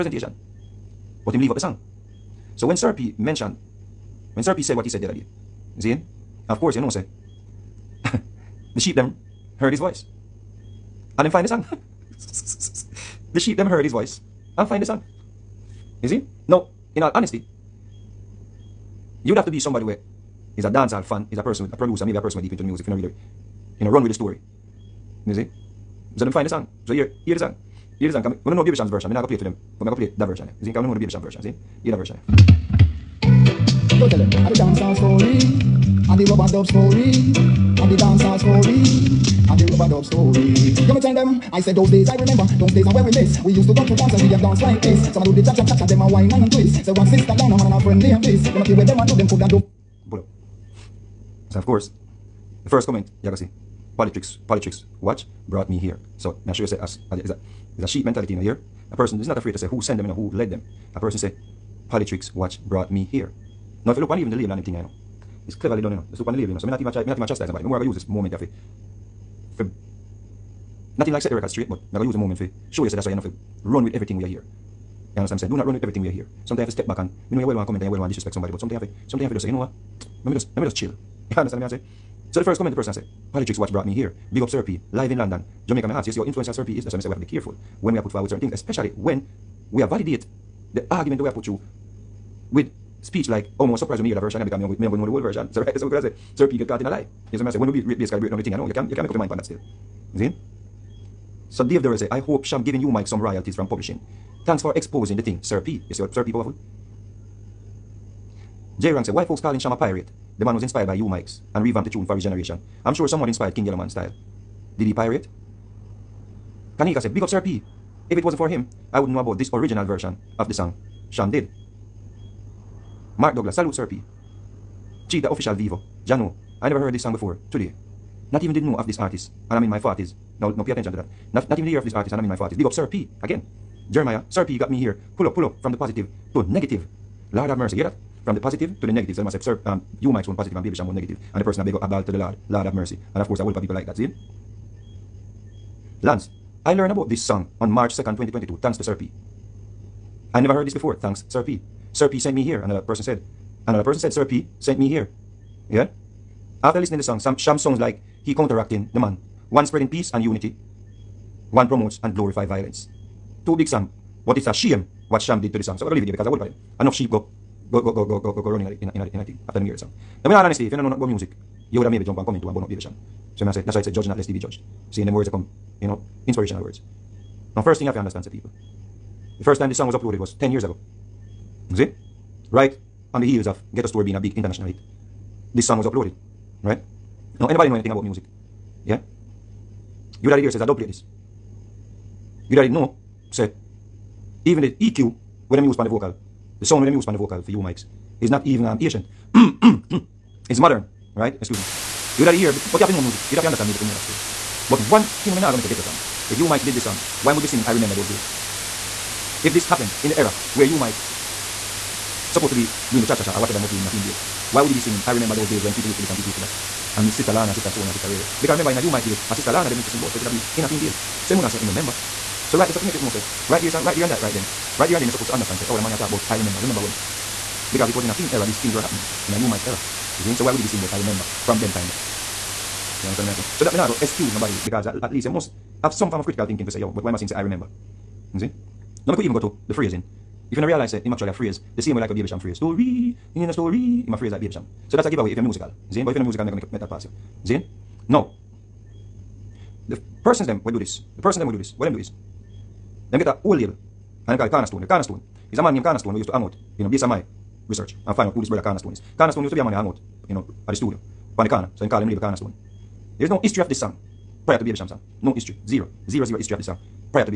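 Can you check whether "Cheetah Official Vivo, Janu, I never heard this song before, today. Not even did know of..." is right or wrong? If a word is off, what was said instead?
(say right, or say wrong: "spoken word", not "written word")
right.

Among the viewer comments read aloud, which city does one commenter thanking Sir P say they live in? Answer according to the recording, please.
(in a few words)
London.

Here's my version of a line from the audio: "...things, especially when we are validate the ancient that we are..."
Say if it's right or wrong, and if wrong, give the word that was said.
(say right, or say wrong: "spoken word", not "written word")
wrong: "argument", not "ancient".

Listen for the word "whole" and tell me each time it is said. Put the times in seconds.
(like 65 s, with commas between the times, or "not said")
95 s, 253 s.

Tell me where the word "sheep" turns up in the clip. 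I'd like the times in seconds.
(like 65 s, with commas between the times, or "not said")
8 s, 13 s, 57 s, 166 s.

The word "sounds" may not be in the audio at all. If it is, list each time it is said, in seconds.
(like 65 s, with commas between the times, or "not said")
157 s, 196 s.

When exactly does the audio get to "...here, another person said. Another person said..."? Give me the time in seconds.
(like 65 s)
152 s.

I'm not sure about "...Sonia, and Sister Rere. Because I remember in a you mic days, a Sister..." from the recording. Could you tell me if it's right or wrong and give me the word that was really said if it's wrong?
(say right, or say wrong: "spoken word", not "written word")
right.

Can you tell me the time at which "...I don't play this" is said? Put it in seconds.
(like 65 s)
190 s.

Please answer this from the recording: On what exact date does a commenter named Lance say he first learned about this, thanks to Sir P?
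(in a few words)
March 2, 2022.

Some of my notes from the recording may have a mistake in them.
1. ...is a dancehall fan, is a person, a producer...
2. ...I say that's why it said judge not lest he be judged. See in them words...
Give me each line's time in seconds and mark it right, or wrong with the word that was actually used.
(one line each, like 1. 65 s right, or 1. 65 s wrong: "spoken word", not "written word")
1. 20 s right
2. 173 s right.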